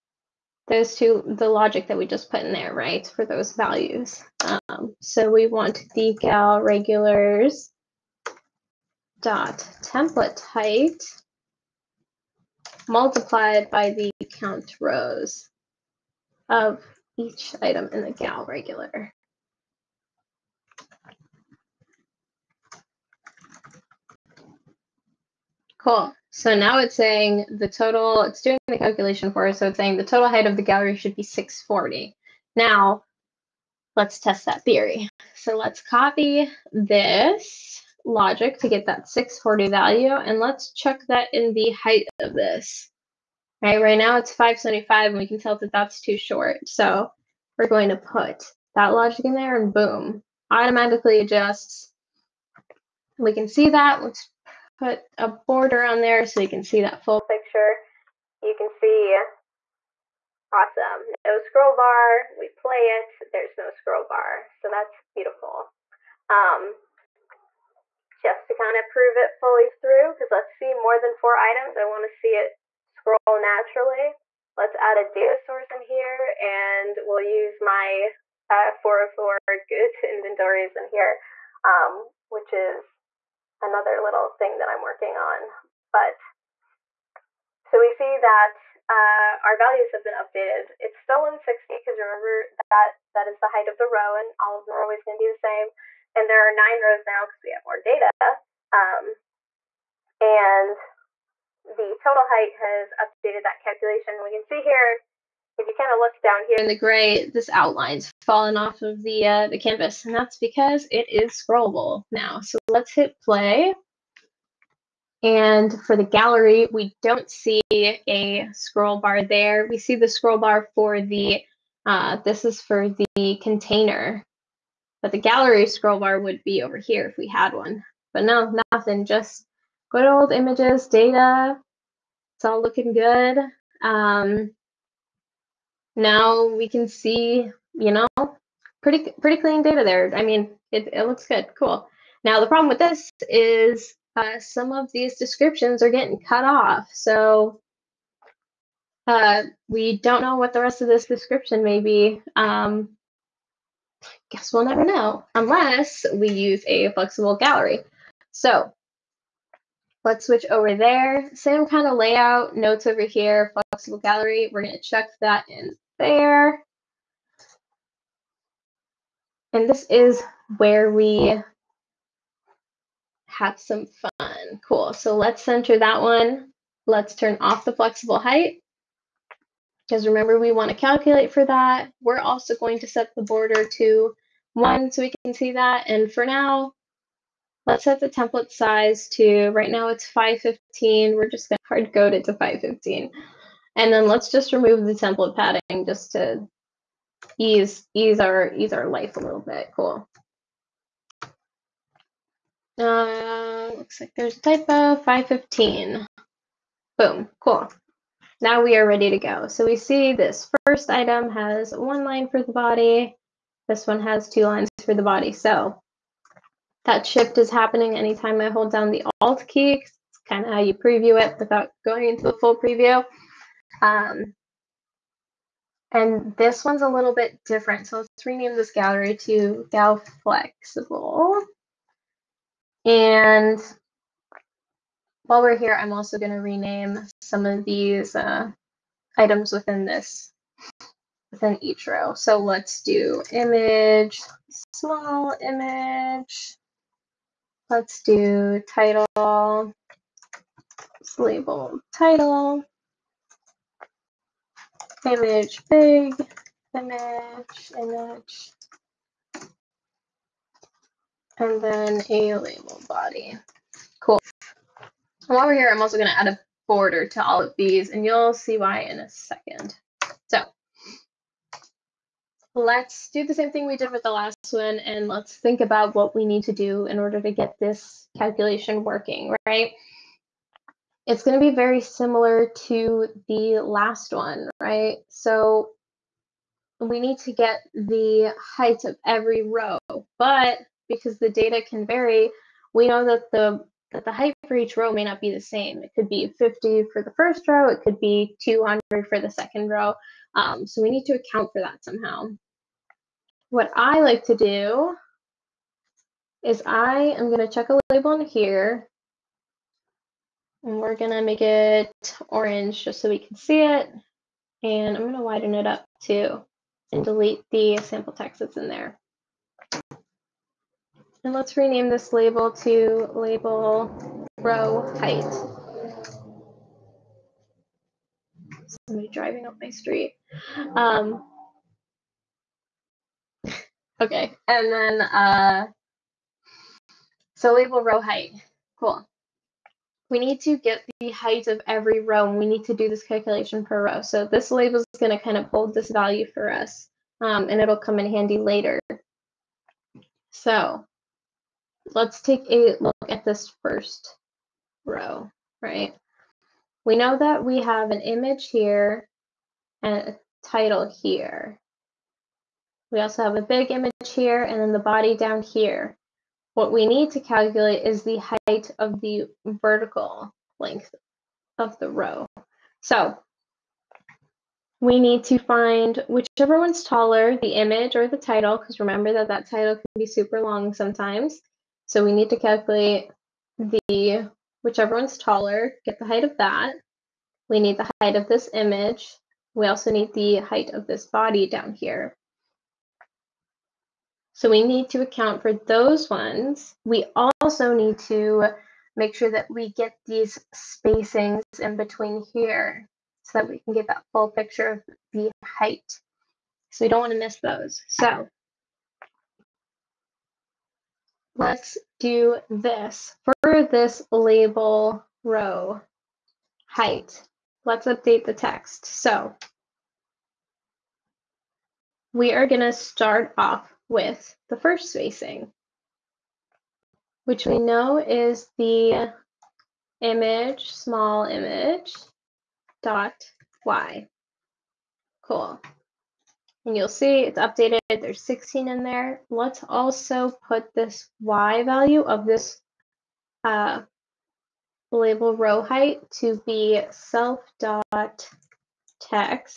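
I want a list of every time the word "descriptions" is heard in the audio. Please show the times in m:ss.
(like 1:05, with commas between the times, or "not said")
2:25, 2:31.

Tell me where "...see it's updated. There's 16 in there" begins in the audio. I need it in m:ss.
7:16.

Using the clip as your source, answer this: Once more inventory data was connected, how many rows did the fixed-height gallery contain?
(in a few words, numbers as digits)
9.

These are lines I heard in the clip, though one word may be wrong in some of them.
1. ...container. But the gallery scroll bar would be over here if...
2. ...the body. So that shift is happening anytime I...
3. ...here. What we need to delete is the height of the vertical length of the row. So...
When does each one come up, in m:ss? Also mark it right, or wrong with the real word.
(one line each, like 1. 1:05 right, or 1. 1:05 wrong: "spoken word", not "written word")
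1. 2:03 right
2. 3:34 right
3. 6:05 wrong: "calculate", not "delete".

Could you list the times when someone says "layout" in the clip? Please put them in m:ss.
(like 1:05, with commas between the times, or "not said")
2:41.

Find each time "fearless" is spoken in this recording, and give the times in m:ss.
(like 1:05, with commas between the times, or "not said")
not said.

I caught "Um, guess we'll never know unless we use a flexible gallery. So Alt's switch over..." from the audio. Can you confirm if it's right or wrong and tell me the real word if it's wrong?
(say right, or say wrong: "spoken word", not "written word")
wrong: "Let", not "Alt".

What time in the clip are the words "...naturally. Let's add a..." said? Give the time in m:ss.
1:13.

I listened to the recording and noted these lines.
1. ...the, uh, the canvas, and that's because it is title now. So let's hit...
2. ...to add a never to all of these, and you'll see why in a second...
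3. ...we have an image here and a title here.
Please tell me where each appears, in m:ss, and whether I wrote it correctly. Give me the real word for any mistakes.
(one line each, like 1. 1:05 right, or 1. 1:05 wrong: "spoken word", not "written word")
1. 1:49 wrong: "scrollable", not "title"
2. 4:26 wrong: "border", not "never"
3. 5:57 right.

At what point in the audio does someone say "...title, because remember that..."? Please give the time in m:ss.
6:18.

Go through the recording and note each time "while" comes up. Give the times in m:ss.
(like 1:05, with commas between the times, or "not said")
3:55, 4:25.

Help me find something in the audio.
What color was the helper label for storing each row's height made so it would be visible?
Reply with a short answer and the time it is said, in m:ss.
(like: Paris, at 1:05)
Orange, at 5:12.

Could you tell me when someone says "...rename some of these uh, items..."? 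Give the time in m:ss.
3:56.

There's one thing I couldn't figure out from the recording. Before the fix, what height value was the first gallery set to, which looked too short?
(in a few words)
575.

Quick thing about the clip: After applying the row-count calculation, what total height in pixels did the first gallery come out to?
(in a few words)
640.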